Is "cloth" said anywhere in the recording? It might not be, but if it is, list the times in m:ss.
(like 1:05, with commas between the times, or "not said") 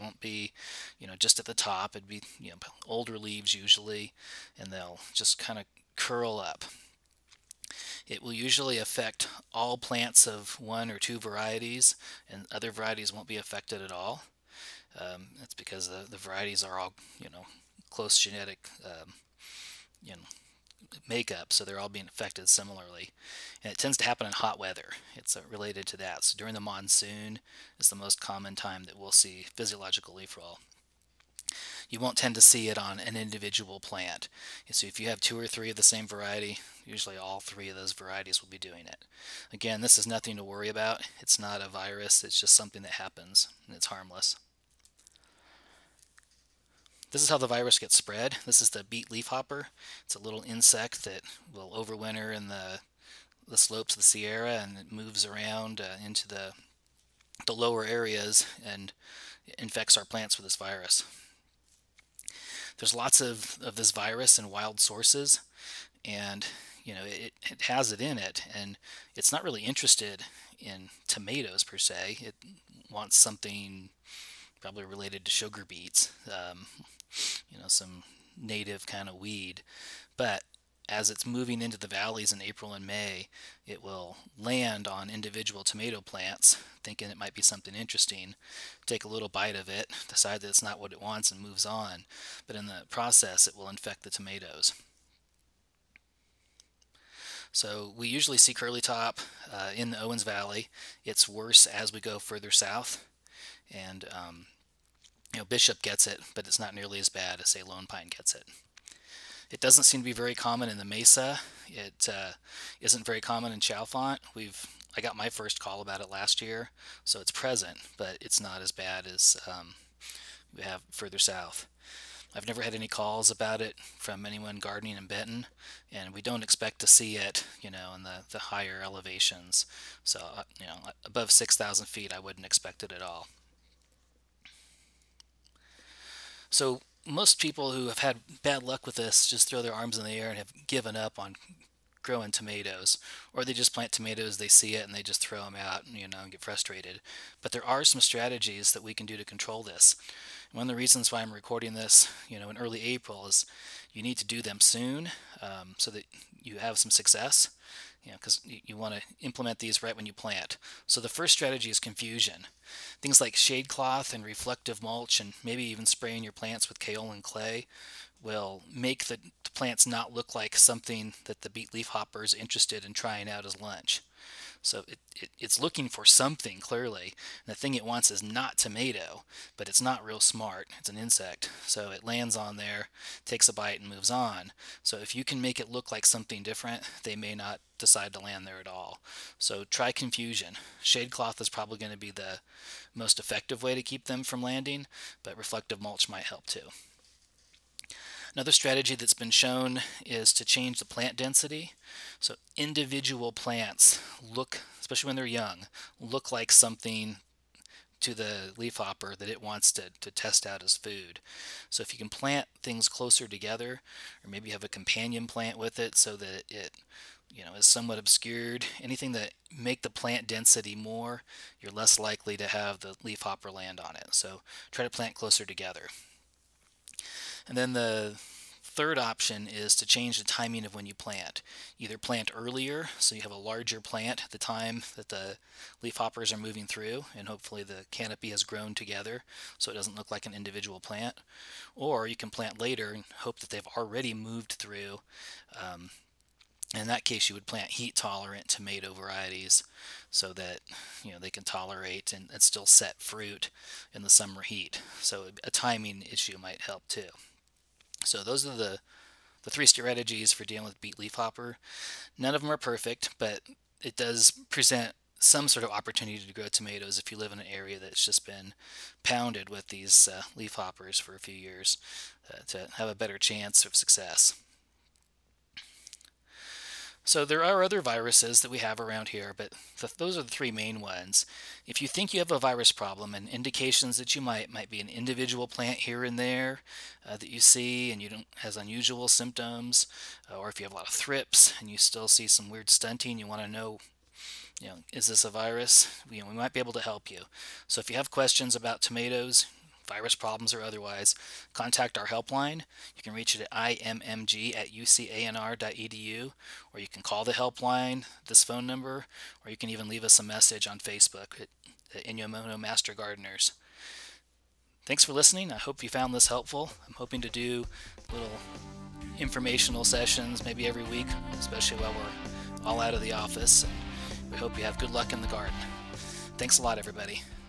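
2:43, 3:11.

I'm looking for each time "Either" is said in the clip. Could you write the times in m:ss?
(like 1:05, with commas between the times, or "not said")
3:51.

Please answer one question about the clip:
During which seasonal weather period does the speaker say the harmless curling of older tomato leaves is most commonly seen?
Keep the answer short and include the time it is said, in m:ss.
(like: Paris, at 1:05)
The monsoon, at 0:26.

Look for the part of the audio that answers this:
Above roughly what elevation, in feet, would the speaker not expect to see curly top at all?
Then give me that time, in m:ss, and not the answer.
2:11.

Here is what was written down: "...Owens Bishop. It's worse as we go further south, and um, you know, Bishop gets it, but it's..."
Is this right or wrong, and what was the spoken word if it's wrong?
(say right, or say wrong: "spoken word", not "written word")
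wrong: "Valley", not "Bishop".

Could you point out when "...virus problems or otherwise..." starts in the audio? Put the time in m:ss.
4:59.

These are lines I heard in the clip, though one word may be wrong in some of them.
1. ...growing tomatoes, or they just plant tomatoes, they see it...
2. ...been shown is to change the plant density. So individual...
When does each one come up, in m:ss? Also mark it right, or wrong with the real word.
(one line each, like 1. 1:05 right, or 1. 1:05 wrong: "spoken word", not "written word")
1. 2:22 right
2. 3:19 right.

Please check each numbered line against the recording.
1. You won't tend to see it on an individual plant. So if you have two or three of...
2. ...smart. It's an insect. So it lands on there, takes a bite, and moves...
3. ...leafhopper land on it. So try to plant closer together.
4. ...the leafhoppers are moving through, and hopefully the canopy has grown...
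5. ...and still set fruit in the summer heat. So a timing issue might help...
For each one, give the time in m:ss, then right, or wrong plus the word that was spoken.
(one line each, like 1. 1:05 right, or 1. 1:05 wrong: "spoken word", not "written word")
1. 0:31 right
2. 3:00 right
3. 3:43 right
4. 3:55 right
5. 4:12 right.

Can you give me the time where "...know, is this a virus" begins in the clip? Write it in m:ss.
4:54.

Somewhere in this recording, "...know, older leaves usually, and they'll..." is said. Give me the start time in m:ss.
0:02.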